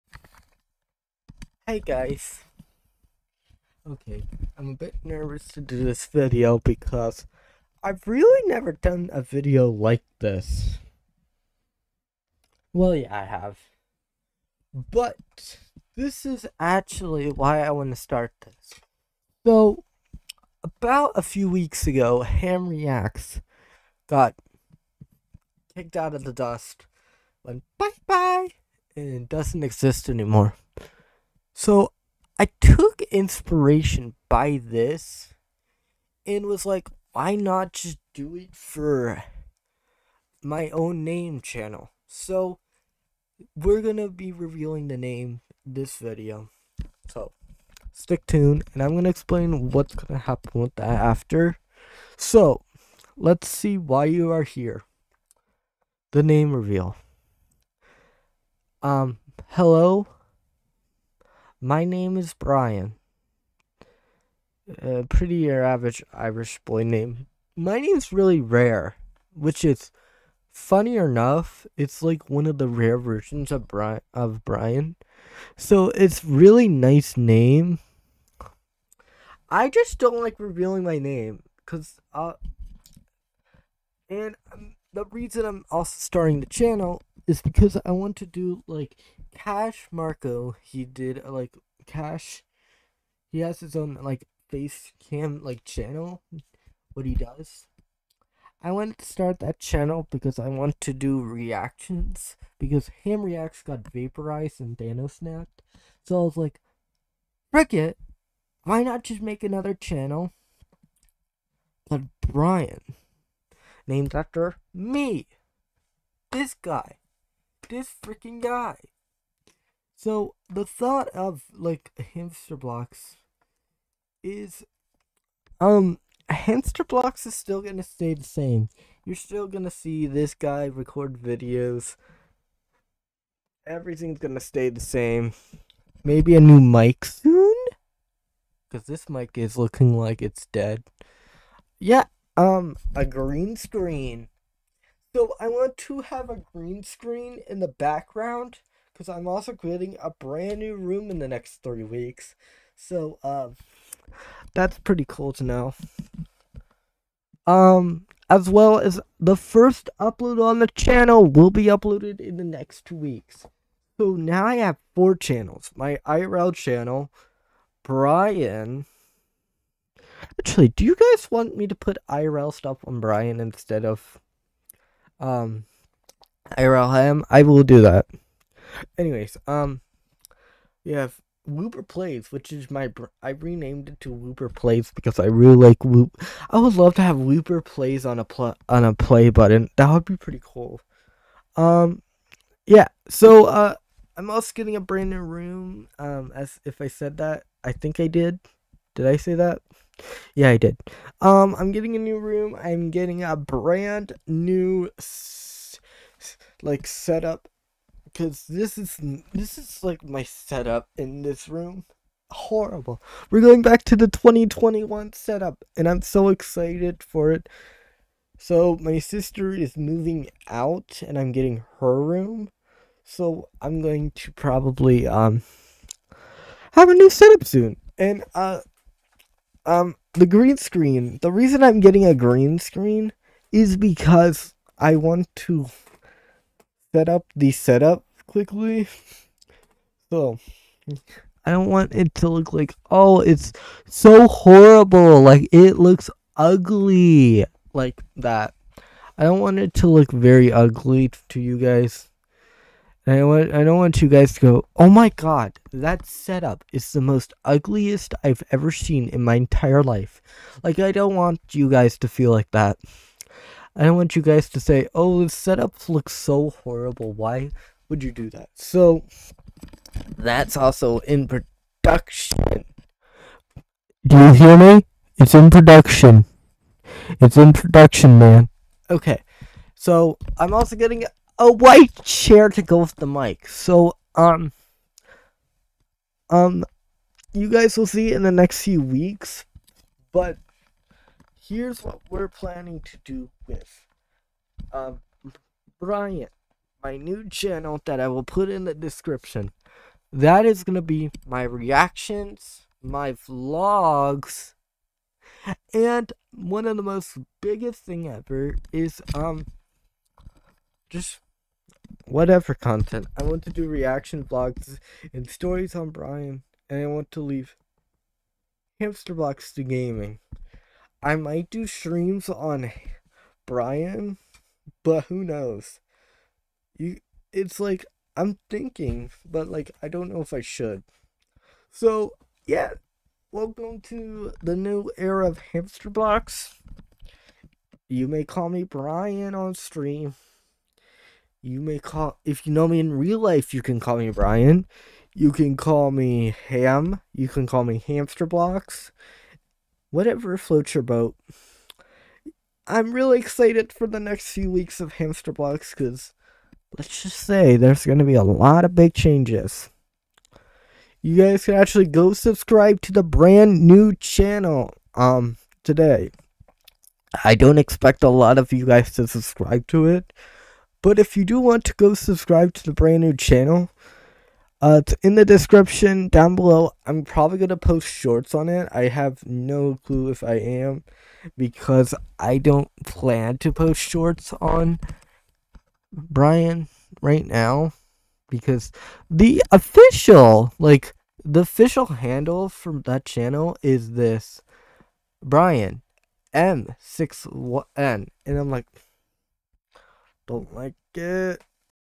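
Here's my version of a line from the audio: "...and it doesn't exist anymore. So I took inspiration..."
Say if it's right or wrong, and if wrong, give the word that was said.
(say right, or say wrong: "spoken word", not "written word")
right.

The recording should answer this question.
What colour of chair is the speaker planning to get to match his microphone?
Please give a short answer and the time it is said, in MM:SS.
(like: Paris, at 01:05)
White, at 04:41.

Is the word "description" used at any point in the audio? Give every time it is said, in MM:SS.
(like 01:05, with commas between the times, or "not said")
04:58, 06:15.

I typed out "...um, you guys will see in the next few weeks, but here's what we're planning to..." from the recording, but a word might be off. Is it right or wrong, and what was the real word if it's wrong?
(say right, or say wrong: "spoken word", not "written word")
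right.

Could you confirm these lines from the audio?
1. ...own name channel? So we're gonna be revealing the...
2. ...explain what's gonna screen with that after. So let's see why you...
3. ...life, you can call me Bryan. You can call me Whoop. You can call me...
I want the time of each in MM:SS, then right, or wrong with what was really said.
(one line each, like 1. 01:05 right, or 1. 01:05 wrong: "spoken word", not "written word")
1. 00:40 right
2. 00:49 wrong: "happen", not "screen"
3. 05:43 wrong: "Ham", not "Whoop".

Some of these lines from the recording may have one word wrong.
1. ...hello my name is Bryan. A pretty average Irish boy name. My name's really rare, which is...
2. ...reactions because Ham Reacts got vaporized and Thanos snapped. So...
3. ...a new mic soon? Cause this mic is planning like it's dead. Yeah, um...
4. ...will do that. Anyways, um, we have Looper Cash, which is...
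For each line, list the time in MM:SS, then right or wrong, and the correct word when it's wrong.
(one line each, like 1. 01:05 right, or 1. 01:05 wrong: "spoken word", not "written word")
1. 00:59 right
2. 01:41 right
3. 02:16 wrong: "looking", not "planning"
4. 02:57 wrong: "Plays", not "Cash".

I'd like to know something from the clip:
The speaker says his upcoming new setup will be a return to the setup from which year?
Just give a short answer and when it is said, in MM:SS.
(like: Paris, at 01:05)
2021, at 03:34.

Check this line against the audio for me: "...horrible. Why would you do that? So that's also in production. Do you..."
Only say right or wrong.
right.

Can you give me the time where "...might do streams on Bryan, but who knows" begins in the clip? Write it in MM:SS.
05:21.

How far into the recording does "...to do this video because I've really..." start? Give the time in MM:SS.
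00:05.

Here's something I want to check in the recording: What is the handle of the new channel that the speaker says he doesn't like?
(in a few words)
Bryan M61N.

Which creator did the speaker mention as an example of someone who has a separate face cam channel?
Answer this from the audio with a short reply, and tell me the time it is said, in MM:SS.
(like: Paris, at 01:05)
Cash Marco, at 01:29.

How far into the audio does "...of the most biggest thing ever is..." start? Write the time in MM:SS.
05:06.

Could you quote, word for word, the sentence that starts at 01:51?
But Bryan, named after me, this guy this freaking guy.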